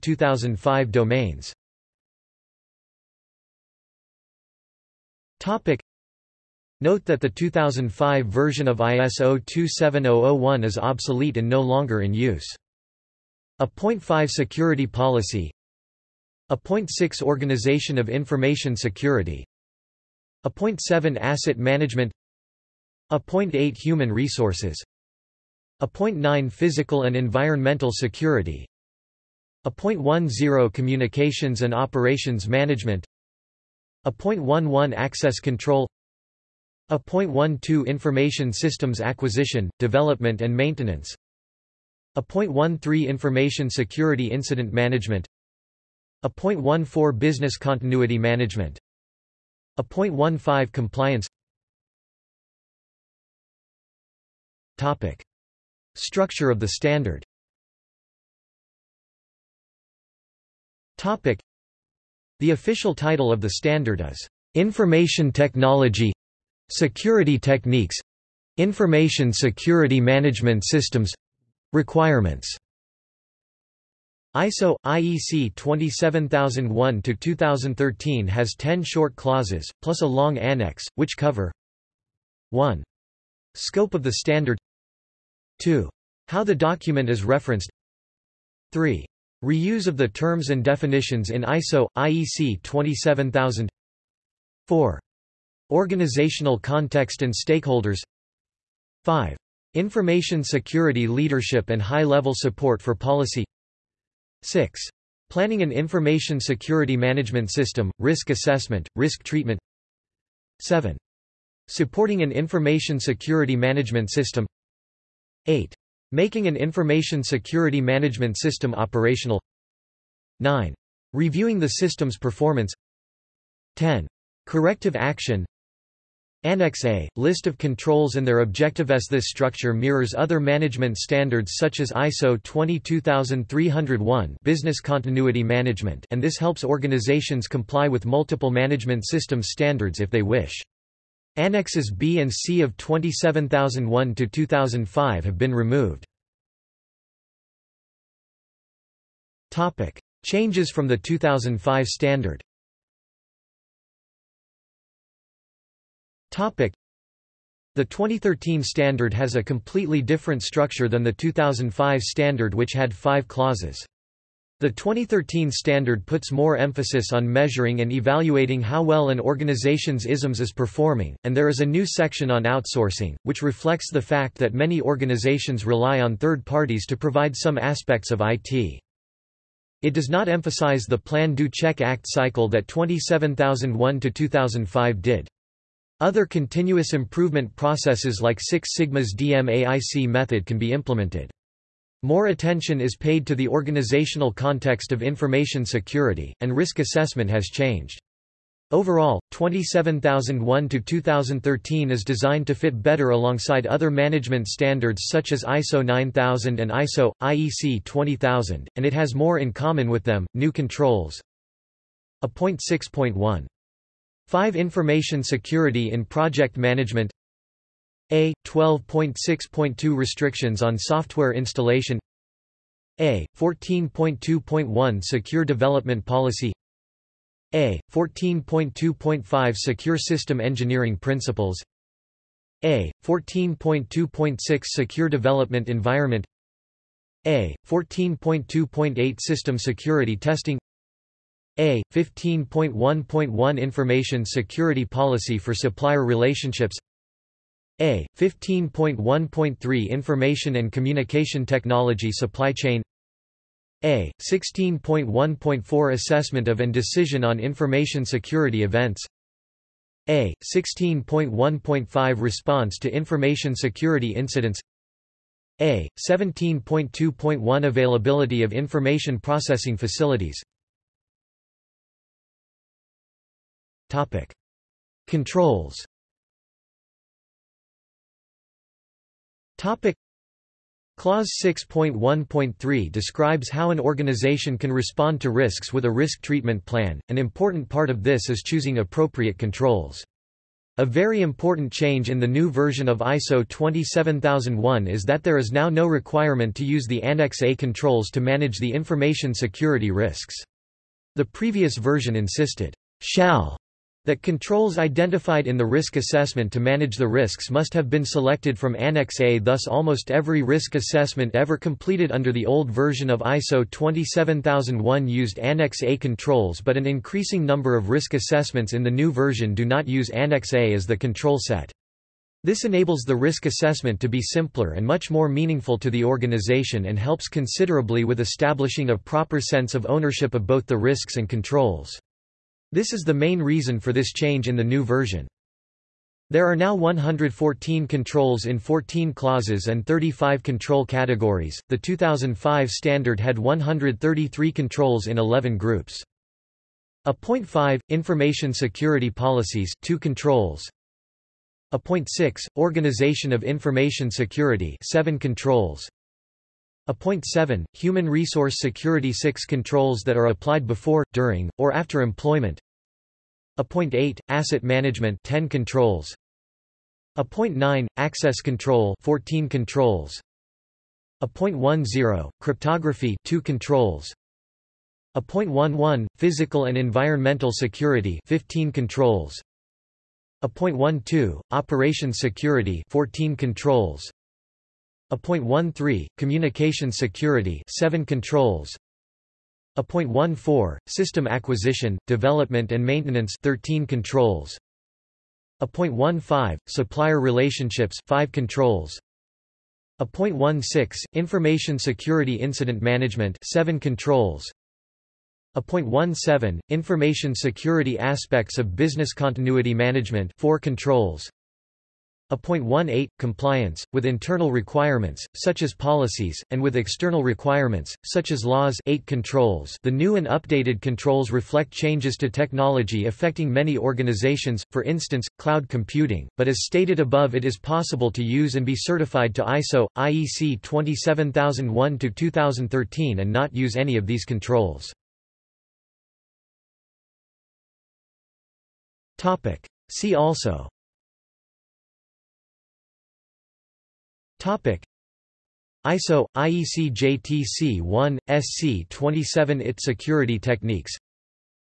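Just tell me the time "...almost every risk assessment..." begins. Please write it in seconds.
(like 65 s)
309 s.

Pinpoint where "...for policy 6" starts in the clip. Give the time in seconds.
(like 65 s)
102 s.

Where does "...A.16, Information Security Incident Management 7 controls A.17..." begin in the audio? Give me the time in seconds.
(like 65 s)
399 s.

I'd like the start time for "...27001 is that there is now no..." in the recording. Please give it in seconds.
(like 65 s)
293 s.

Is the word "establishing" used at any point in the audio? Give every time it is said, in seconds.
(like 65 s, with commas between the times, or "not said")
328 s.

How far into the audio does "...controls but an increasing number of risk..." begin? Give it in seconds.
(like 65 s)
315 s.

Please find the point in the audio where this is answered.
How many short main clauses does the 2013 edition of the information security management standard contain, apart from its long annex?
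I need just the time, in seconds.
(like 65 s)
78 s.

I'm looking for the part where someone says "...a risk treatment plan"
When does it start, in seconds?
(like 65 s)
285 s.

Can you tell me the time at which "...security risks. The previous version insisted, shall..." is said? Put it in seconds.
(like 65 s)
299 s.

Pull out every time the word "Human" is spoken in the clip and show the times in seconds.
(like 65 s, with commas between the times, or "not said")
23 s, 357 s.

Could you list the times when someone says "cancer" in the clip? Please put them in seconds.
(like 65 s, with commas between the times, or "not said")
not said.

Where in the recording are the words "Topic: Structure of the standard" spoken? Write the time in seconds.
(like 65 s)
54 s.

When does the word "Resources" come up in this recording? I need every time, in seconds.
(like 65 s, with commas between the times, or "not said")
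24 s, 358 s.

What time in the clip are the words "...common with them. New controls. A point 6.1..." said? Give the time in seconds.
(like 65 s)
209 s.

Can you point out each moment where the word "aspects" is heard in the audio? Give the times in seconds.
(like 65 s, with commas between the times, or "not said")
177 s, 407 s.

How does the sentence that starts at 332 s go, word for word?
This is the main reason for this change in the new version.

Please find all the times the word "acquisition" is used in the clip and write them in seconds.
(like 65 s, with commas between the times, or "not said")
39 s, 391 s.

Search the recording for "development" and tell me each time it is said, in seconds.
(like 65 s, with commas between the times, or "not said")
39 s, 225 s, 235 s, 392 s.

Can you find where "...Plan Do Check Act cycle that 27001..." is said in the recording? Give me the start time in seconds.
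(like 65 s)
180 s.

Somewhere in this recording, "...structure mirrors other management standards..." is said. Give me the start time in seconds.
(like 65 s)
129 s.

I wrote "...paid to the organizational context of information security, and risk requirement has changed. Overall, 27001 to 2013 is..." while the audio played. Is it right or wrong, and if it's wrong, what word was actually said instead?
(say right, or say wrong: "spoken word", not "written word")
wrong: "assessment", not "requirement".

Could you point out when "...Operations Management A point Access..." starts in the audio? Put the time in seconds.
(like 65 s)
31 s.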